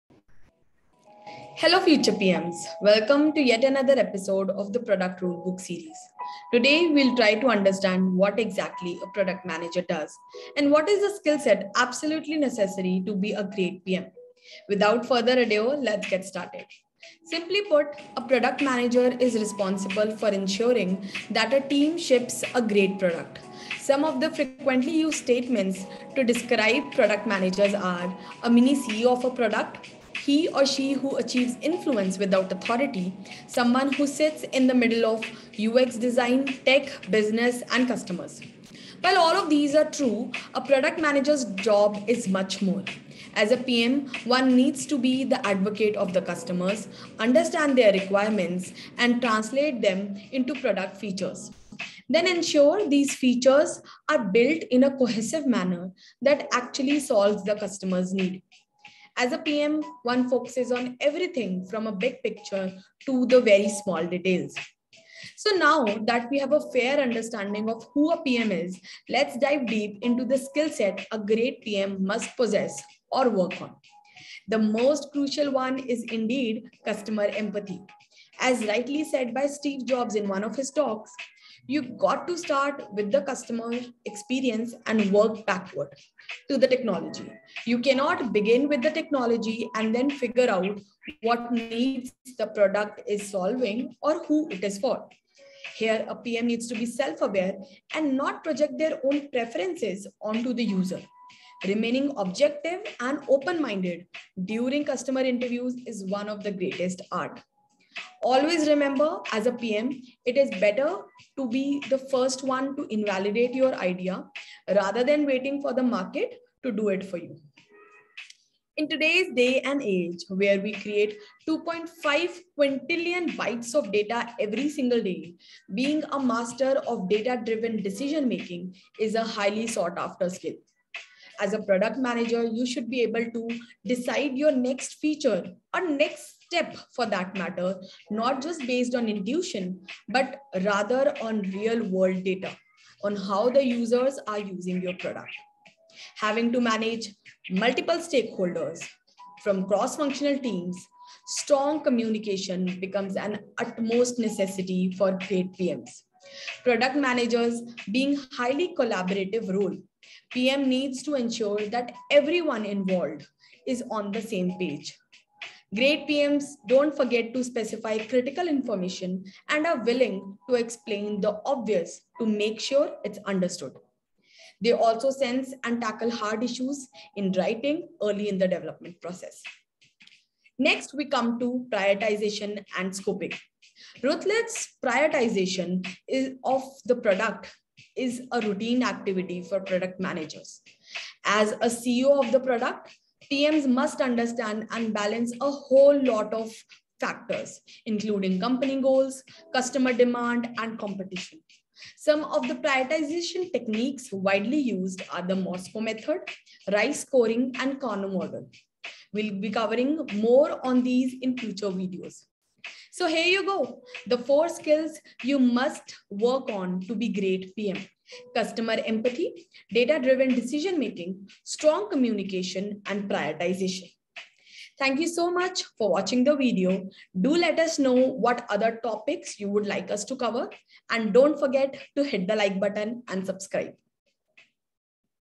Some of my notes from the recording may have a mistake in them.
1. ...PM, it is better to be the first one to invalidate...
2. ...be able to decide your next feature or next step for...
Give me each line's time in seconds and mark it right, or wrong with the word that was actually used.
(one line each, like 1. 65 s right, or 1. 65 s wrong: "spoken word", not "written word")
1. 109 s right
2. 132 s right.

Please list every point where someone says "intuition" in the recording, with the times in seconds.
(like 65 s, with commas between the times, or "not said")
139 s.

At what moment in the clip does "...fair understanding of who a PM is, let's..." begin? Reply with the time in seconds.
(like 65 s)
66 s.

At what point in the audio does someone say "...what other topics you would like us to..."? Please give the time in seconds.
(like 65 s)
227 s.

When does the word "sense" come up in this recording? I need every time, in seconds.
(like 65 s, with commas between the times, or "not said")
175 s.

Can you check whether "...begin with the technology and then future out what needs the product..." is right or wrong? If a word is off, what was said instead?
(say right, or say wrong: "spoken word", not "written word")
wrong: "figure", not "future".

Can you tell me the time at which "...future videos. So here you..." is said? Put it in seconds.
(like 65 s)
211 s.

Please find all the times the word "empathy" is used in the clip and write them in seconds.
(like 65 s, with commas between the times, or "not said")
77 s, 218 s.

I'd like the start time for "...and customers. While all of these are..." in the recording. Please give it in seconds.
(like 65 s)
37 s.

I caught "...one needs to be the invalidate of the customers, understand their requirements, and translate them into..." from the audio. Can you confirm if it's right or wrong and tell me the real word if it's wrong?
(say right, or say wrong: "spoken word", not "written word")
wrong: "advocate", not "invalidate".